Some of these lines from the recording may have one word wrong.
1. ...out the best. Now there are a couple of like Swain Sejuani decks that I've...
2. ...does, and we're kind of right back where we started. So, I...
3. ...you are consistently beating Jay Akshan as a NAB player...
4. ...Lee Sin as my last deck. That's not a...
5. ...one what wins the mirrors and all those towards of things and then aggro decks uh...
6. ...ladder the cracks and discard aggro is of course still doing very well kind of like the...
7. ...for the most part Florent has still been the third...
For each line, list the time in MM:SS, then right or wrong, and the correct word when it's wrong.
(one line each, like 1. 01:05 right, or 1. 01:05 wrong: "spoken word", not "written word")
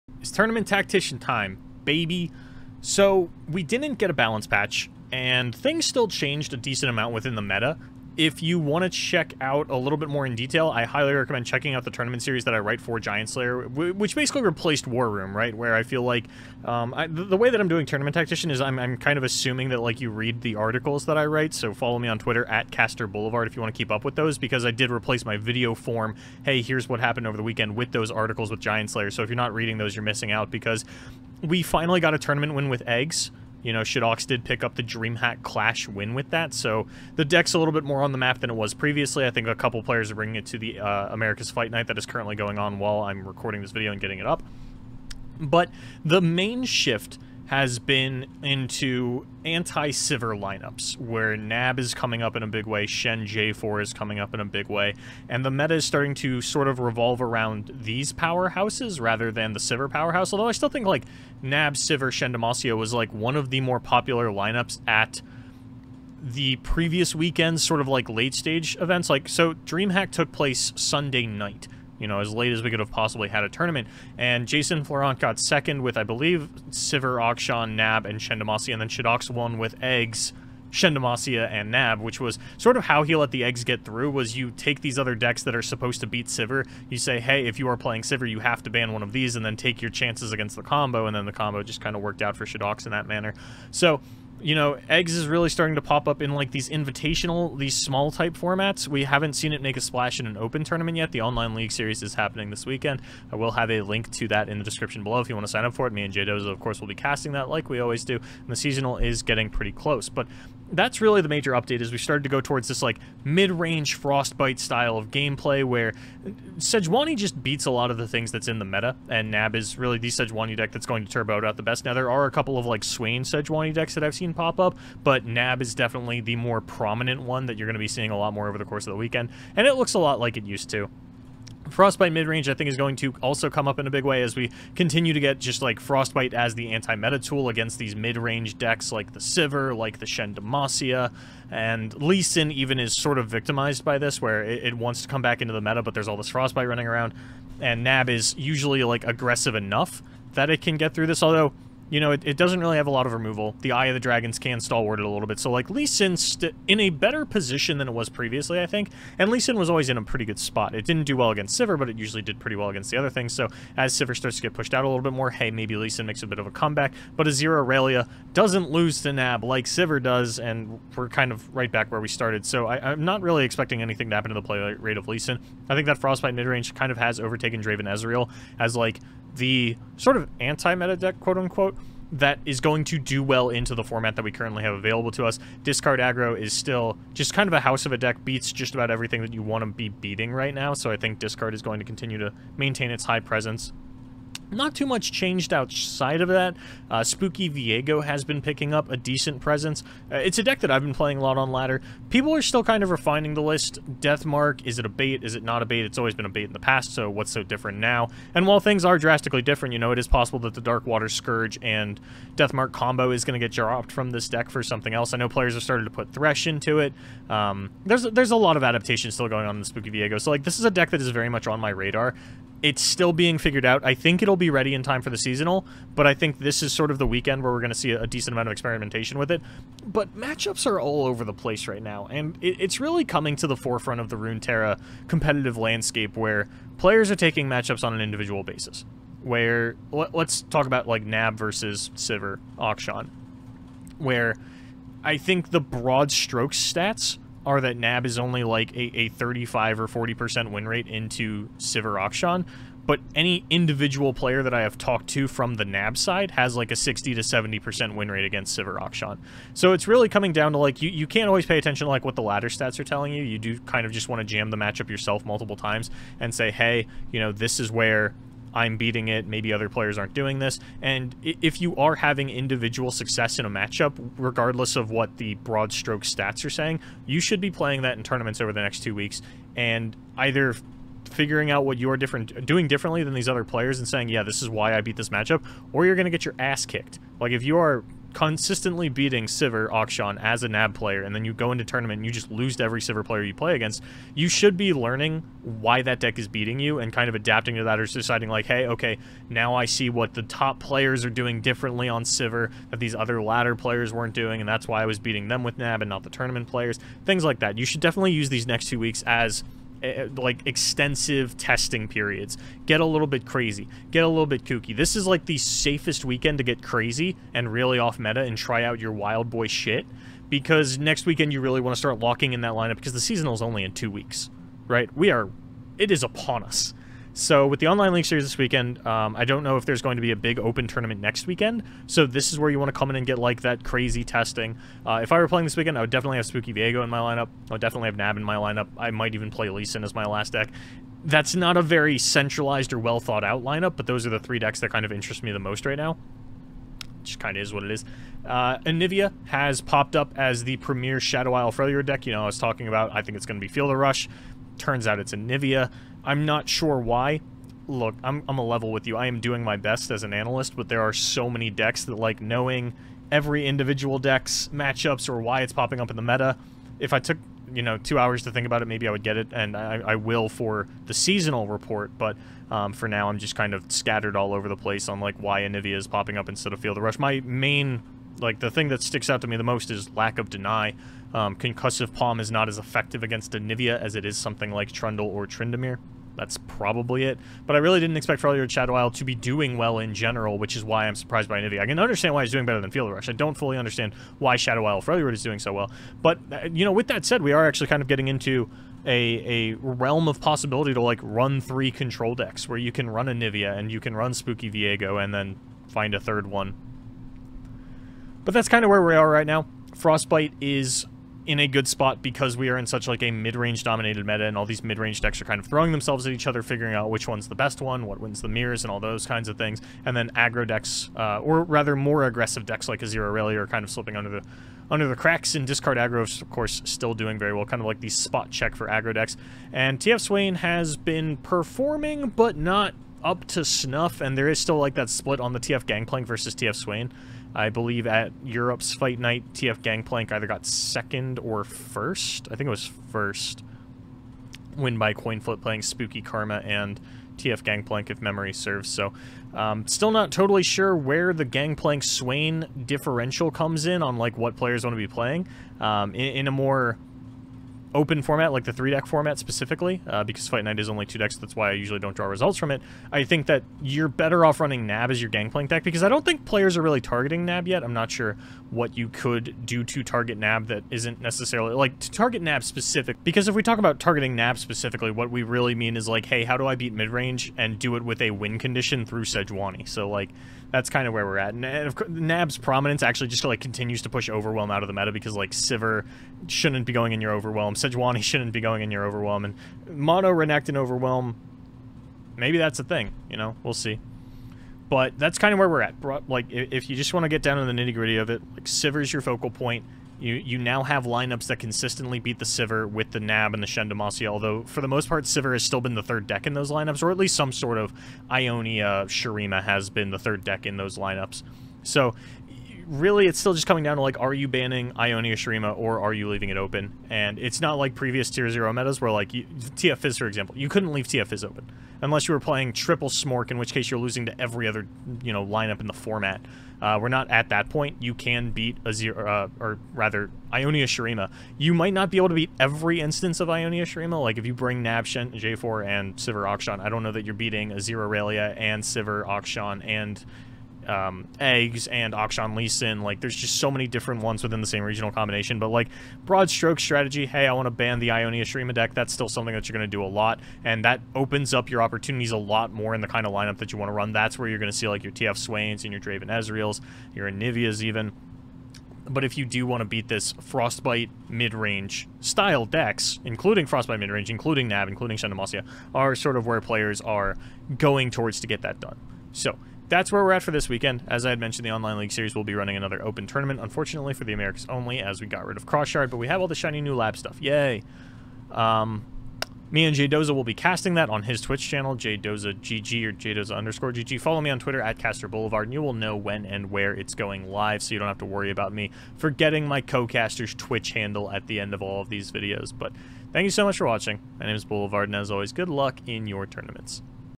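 1. 02:01 right
2. 02:50 right
3. 04:47 wrong: "Sivir", not "Jay"
4. 05:39 right
5. 06:57 wrong: "kinds", not "towards"
6. 07:04 wrong: "under", not "ladder"
7. 08:24 wrong: "Sivir", not "Florent".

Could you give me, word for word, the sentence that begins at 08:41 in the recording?
Unless you were playing triple Smork, in which case you're losing to every other, you know, lineup in the format.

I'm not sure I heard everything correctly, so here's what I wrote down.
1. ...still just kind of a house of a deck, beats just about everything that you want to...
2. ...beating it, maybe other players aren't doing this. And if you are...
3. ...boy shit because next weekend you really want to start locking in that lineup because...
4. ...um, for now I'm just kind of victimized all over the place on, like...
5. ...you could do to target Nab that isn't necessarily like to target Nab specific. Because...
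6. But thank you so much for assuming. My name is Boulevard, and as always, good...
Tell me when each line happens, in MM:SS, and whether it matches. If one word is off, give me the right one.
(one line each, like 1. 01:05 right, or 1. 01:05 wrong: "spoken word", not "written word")
1. 03:06 right
2. 04:28 right
3. 05:19 right
4. 06:12 wrong: "scattered", not "victimized"
5. 07:48 right
6. 09:52 wrong: "watching", not "assuming".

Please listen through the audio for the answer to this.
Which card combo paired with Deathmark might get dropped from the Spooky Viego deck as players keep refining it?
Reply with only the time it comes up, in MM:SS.
03:30.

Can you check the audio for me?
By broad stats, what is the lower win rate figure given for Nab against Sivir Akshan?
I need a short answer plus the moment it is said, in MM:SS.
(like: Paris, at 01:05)
35, at 04:09.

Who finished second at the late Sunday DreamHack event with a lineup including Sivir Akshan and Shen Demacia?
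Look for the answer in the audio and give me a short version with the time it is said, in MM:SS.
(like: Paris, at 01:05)
Jason Florent, at 01:14.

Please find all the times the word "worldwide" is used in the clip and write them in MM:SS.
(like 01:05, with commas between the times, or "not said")
not said.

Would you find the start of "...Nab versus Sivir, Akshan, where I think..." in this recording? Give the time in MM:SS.
04:01.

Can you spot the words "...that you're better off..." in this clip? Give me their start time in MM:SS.
07:43.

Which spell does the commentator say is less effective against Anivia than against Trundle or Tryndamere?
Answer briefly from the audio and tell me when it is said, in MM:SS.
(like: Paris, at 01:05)
Concussive Palm, at 06:21.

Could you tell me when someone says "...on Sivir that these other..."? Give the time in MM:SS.
05:01.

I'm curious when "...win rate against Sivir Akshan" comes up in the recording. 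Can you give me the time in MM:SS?
04:17.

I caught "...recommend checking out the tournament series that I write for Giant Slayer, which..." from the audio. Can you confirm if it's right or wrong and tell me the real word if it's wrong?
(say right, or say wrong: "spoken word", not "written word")
right.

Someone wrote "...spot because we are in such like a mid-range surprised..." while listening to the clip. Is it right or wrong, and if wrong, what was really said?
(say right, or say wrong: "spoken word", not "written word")
wrong: "dominated", not "surprised".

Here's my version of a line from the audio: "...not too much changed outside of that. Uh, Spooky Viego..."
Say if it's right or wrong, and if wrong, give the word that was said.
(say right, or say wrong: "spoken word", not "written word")
right.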